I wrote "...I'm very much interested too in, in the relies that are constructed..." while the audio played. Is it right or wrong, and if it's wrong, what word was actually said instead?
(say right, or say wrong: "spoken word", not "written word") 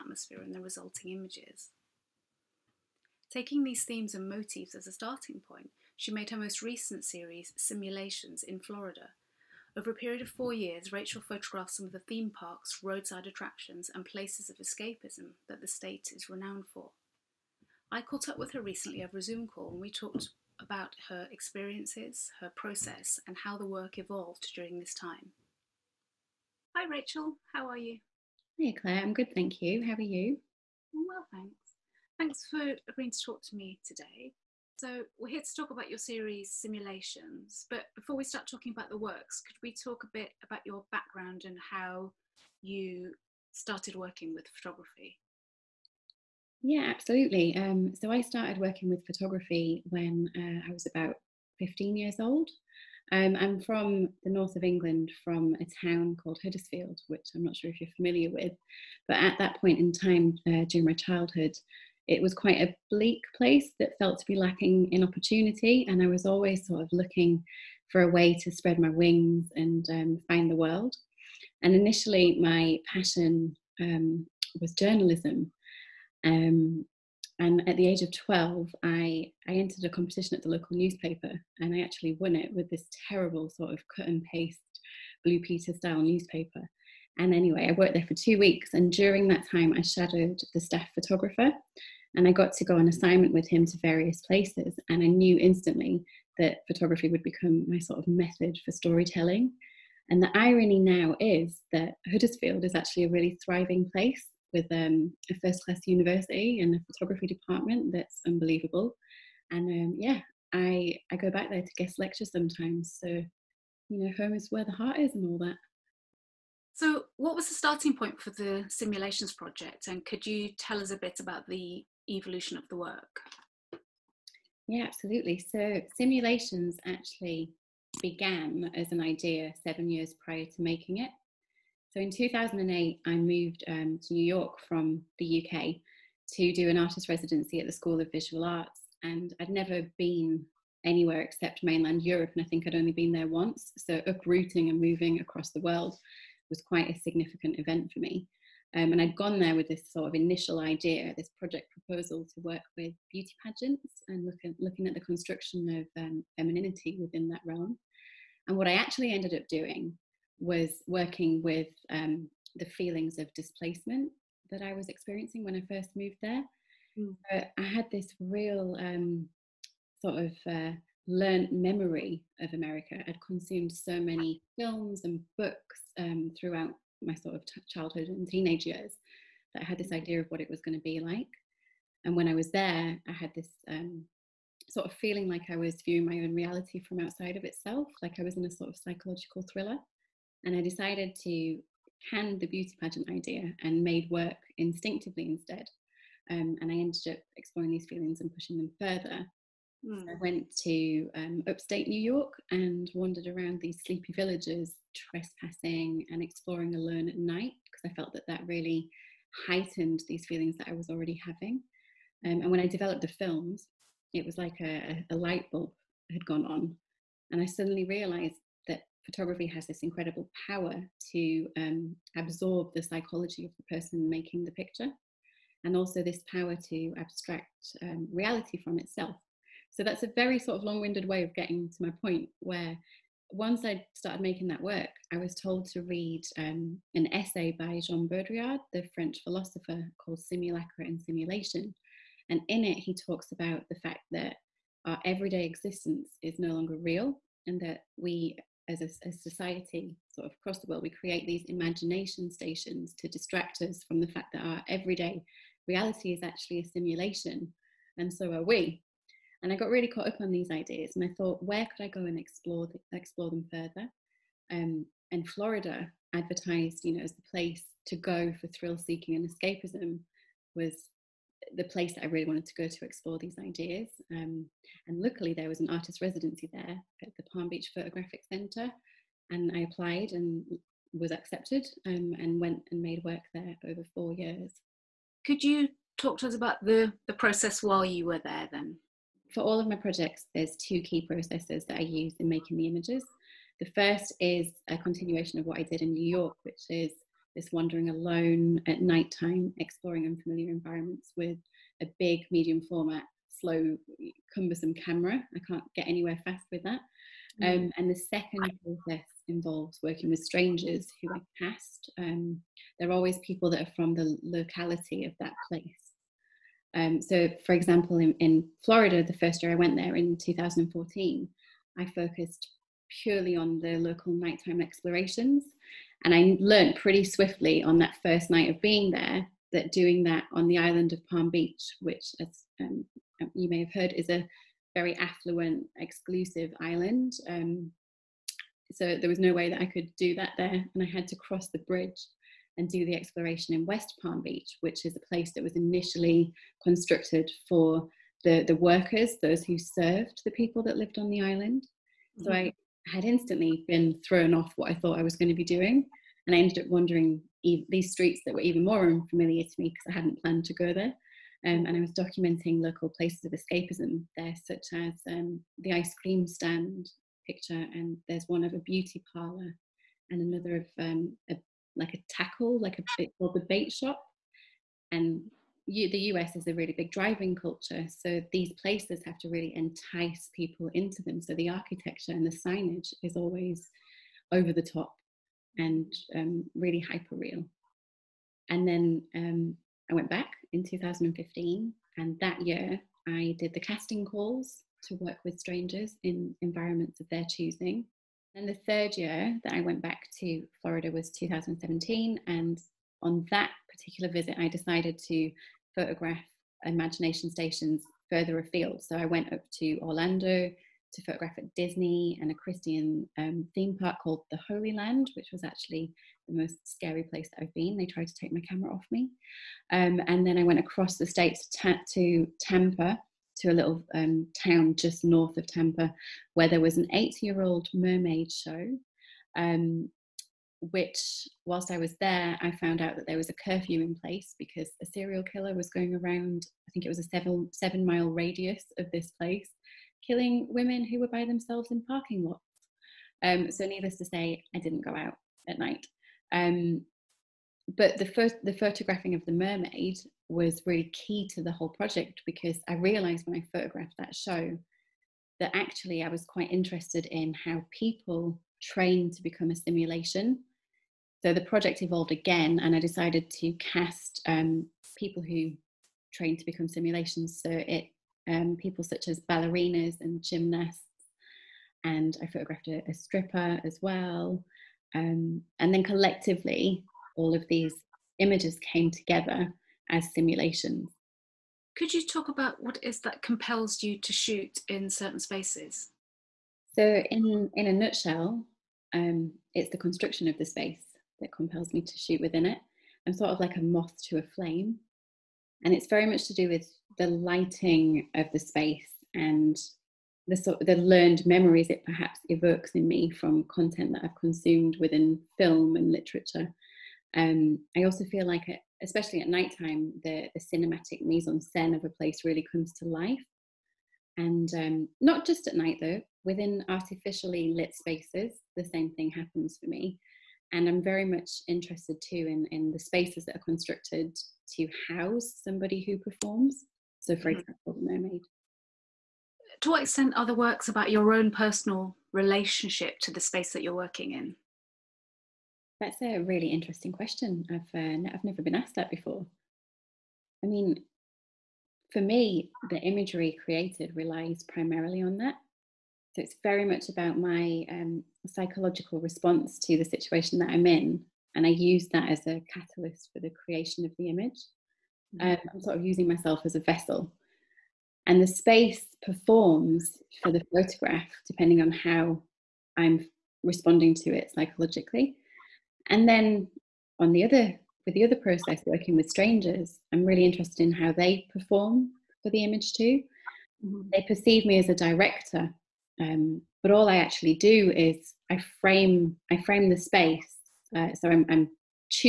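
wrong: "spaces", not "relies".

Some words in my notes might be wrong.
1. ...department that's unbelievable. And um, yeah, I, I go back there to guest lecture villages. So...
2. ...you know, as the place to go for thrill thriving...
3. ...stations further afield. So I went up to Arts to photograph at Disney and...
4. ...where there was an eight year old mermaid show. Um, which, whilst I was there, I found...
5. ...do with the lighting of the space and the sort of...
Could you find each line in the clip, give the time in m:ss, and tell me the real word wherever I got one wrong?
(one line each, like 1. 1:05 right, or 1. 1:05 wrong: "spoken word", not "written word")
1. 1:47 wrong: "sometimes", not "villages"
2. 4:26 wrong: "seeking", not "thriving"
3. 6:47 wrong: "Orlando", not "Arts"
4. 7:06 right
5. 8:16 right.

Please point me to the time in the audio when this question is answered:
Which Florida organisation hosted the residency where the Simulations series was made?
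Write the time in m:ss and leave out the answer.
4:37.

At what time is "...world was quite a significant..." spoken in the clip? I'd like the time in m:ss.
2:25.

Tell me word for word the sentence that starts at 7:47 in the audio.
So it um, people such as ballerinas and gymnasts, and I photographed a, a stripper as well.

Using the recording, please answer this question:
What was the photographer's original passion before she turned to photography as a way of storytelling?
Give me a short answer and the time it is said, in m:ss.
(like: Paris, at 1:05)
Journalism, at 1:14.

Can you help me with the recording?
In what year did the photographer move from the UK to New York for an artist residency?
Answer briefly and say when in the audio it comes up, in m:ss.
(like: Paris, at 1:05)
2008, at 2:12.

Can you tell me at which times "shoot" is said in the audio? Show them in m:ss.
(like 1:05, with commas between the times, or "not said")
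8:04, 8:11.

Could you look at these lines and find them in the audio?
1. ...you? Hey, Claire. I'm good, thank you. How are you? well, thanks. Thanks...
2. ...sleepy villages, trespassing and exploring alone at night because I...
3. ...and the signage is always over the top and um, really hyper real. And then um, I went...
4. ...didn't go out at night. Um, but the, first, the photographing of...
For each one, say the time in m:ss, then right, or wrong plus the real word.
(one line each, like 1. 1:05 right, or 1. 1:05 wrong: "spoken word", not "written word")
1. 0:27 right
2. 3:23 right
3. 6:22 right
4. 7:24 right.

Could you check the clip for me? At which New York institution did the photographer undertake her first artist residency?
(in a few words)
School of Visual Arts.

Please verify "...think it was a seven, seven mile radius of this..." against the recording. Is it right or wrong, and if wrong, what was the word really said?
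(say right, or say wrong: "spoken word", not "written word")
right.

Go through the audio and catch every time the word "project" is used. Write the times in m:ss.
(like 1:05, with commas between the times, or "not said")
1:59, 2:31, 4:49, 7:31, 7:41.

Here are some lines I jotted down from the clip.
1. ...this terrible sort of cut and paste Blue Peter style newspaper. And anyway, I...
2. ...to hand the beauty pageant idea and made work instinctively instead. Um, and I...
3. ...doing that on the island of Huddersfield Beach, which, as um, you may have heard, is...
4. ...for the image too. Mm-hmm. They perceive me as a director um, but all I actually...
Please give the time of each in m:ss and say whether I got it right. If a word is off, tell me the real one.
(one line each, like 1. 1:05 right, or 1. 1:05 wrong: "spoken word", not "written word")
1. 1:22 right
2. 3:11 right
3. 5:29 wrong: "Palm", not "Huddersfield"
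4. 9:32 right.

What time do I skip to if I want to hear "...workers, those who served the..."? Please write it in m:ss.
5:48.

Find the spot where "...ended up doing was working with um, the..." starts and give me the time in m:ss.
2:39.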